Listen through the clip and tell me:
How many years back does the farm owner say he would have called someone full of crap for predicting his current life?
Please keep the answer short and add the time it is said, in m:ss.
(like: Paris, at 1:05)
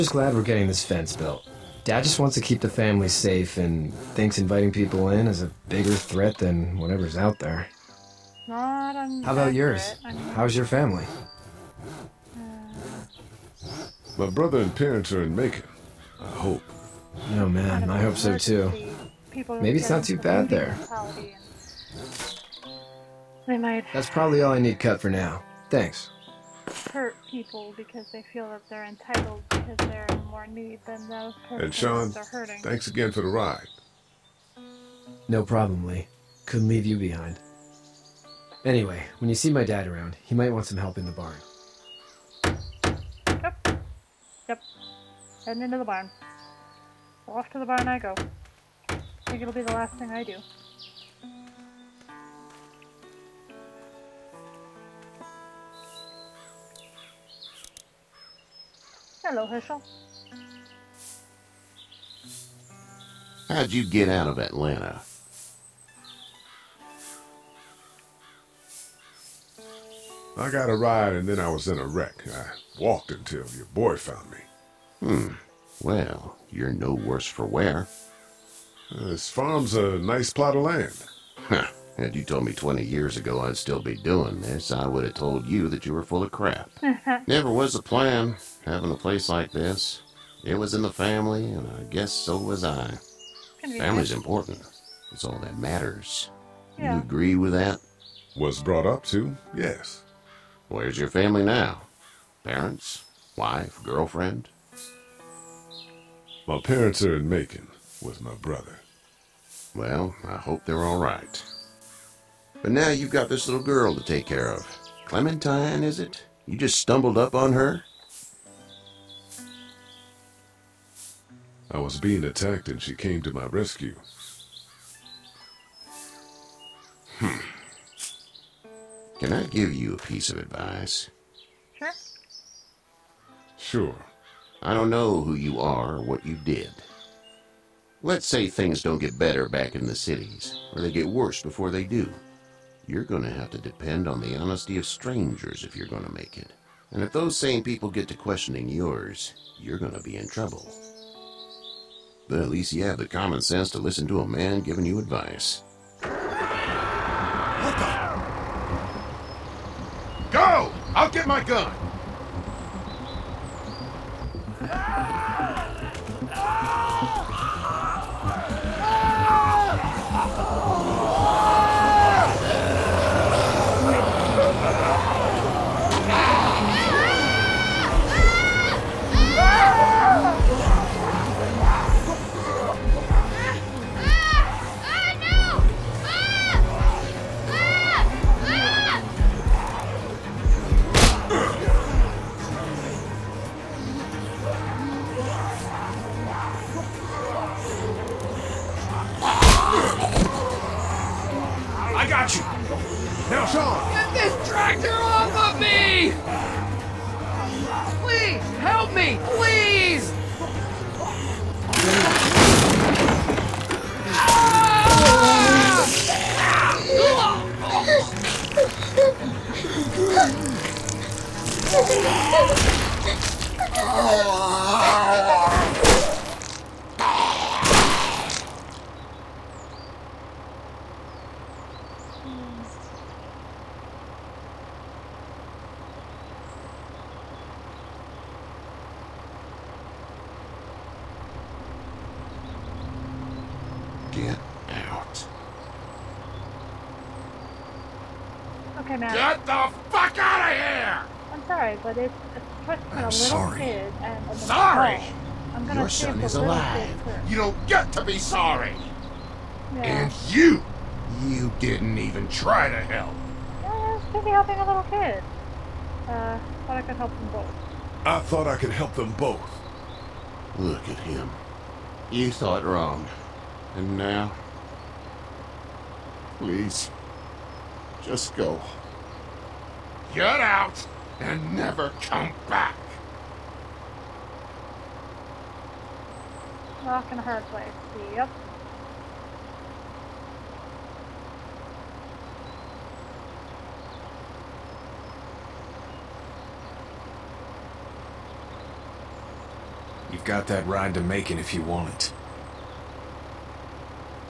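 20, at 1:22.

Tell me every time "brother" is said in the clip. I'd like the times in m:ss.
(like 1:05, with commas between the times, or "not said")
0:14, 1:48.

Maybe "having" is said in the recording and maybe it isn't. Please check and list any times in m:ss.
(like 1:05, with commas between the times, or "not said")
1:28.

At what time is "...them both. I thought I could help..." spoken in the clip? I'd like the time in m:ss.
4:27.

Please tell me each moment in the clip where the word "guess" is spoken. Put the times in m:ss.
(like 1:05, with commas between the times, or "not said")
1:31.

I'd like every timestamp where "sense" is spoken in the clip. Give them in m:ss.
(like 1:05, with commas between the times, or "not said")
2:33.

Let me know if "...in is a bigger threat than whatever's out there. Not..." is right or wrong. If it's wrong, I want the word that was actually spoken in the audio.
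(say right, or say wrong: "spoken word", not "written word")
right.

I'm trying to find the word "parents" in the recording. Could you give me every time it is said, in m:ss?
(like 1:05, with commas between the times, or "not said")
0:14, 1:42, 1:46.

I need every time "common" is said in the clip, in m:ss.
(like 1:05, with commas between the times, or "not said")
2:33.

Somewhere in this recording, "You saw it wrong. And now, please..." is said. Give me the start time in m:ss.
4:32.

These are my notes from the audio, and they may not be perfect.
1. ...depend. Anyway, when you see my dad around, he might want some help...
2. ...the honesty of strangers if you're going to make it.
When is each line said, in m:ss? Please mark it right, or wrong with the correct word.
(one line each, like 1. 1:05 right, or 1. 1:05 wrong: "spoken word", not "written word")
1. 0:36 wrong: "behind", not "depend"
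2. 2:24 right.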